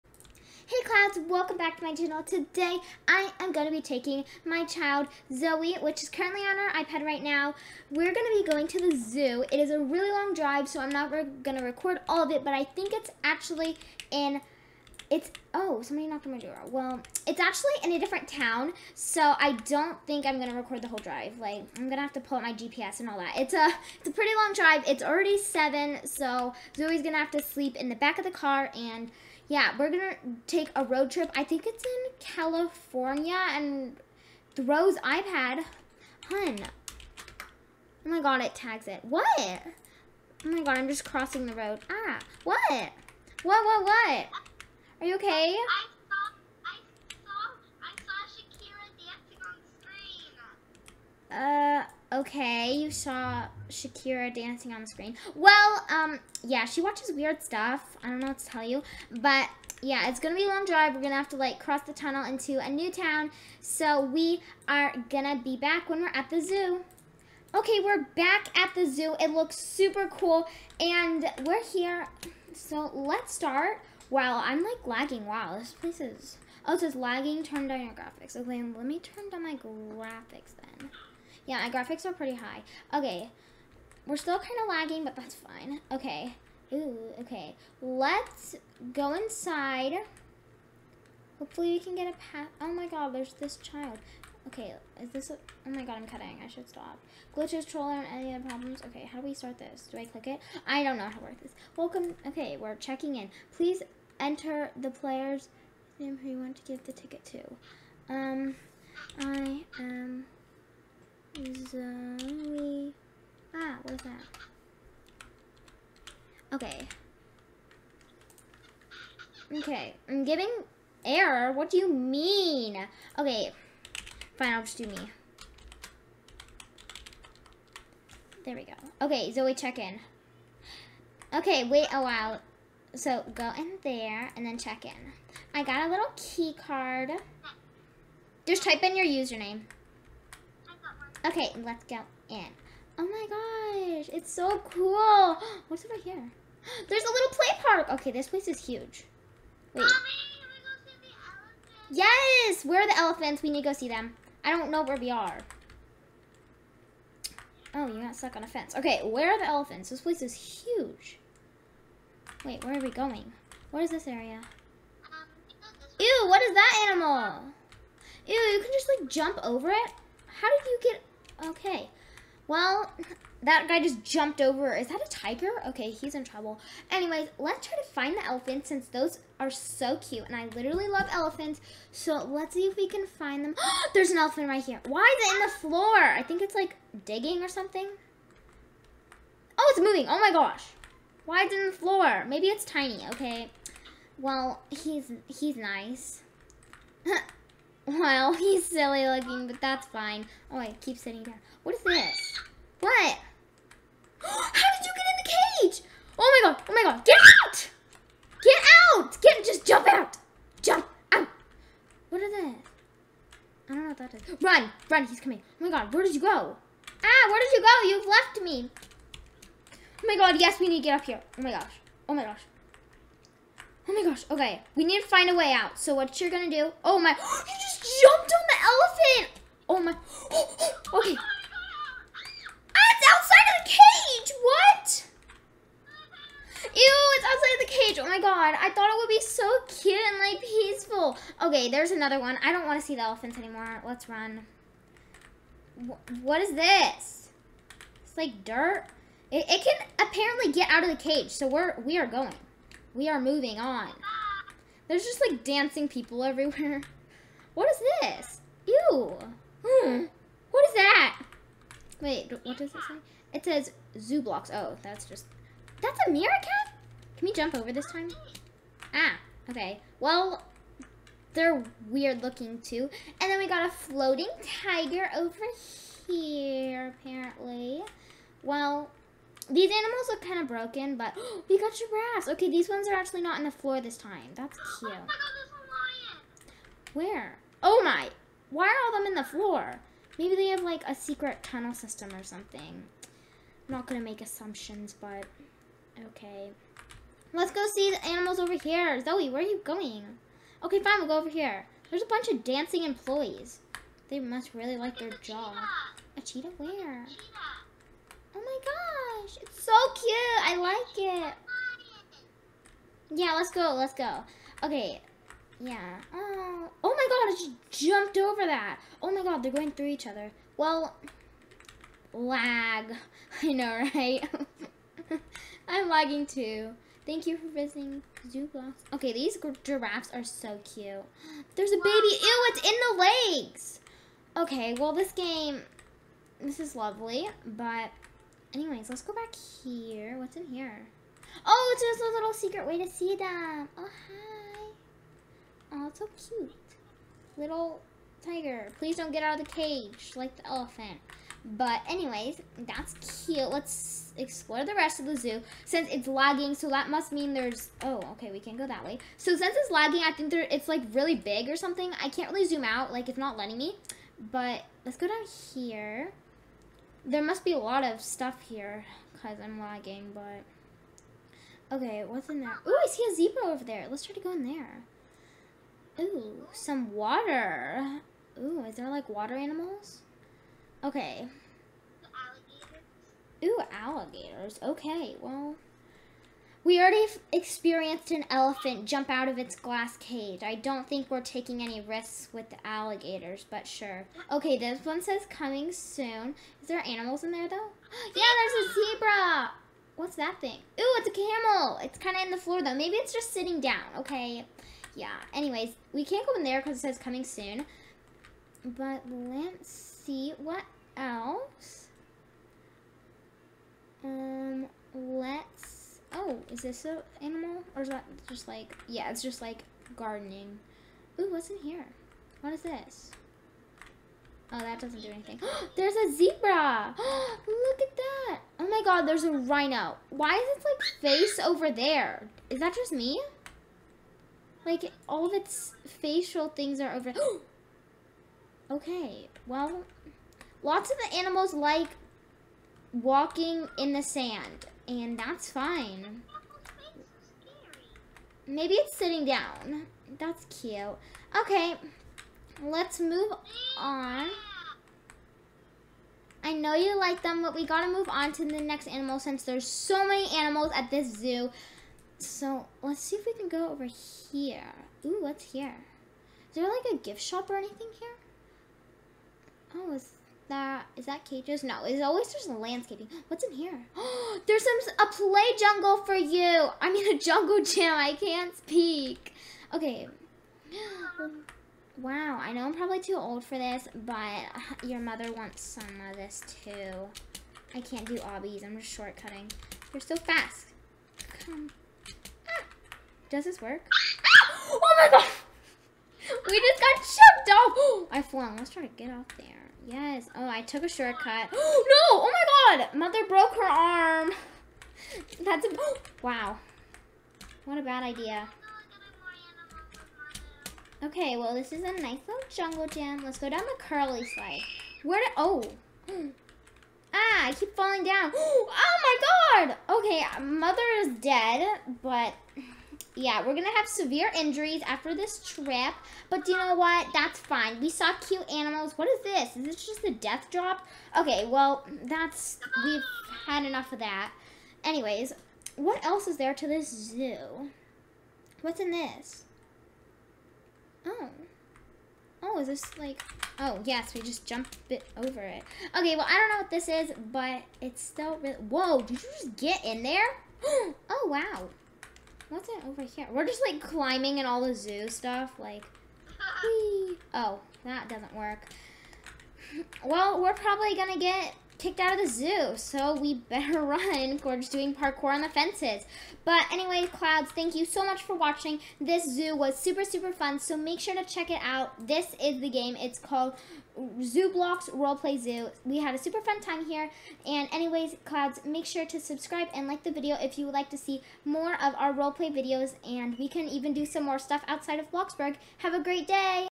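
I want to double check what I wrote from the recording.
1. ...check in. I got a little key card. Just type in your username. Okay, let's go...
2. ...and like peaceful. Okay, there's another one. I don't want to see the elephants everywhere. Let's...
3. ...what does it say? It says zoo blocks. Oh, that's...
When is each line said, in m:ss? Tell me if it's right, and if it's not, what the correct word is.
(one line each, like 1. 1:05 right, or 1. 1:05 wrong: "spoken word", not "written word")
1. 2:14 right
2. 3:59 wrong: "anymore", not "everywhere"
3. 4:22 right.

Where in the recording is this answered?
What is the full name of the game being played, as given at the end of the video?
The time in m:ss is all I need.
9:34.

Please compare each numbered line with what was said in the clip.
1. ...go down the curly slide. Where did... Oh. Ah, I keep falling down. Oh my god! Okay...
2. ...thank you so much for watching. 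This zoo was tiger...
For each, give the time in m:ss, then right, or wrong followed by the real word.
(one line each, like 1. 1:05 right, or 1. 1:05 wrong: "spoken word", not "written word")
1. 8:33 right
2. 9:27 wrong: "super", not "tiger".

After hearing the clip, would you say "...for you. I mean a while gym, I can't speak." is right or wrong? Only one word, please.
wrong.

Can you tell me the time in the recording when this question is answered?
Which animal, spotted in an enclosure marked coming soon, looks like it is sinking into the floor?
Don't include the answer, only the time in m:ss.
6:41.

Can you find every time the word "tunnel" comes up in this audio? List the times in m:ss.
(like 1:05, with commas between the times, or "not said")
1:01, 4:51.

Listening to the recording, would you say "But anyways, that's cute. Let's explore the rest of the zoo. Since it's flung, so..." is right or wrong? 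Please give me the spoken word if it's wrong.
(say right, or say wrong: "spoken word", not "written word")
wrong: "lagging", not "flung".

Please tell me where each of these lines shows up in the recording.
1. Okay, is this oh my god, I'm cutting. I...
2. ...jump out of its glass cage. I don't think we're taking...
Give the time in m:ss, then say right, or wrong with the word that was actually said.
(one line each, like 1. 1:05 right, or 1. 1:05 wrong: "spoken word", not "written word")
1. 1:34 right
2. 6:28 right.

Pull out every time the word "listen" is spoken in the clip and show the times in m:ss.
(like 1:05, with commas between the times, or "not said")
not said.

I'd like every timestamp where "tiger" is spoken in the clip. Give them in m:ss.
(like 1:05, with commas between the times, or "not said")
2:55, 4:34, 5:48.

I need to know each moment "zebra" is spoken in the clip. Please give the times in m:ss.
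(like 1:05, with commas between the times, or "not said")
6:13, 6:38, 7:06.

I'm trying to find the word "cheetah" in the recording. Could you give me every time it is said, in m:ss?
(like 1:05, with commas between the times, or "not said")
5:06.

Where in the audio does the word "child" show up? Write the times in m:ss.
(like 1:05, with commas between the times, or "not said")
0:04, 1:33.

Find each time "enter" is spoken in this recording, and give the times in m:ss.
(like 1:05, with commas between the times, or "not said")
1:44.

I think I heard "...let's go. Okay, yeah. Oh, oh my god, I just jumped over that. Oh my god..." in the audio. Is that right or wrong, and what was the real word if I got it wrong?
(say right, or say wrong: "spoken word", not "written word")
right.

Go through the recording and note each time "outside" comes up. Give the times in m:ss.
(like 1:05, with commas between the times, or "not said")
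3:53, 3:57, 9:44.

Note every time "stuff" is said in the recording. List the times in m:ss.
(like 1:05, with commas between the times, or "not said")
0:57, 6:08, 9:15, 9:44.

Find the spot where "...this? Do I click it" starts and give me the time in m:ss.
1:39.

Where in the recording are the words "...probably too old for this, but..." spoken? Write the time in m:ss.
8:02.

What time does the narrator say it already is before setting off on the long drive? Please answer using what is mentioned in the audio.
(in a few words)
7.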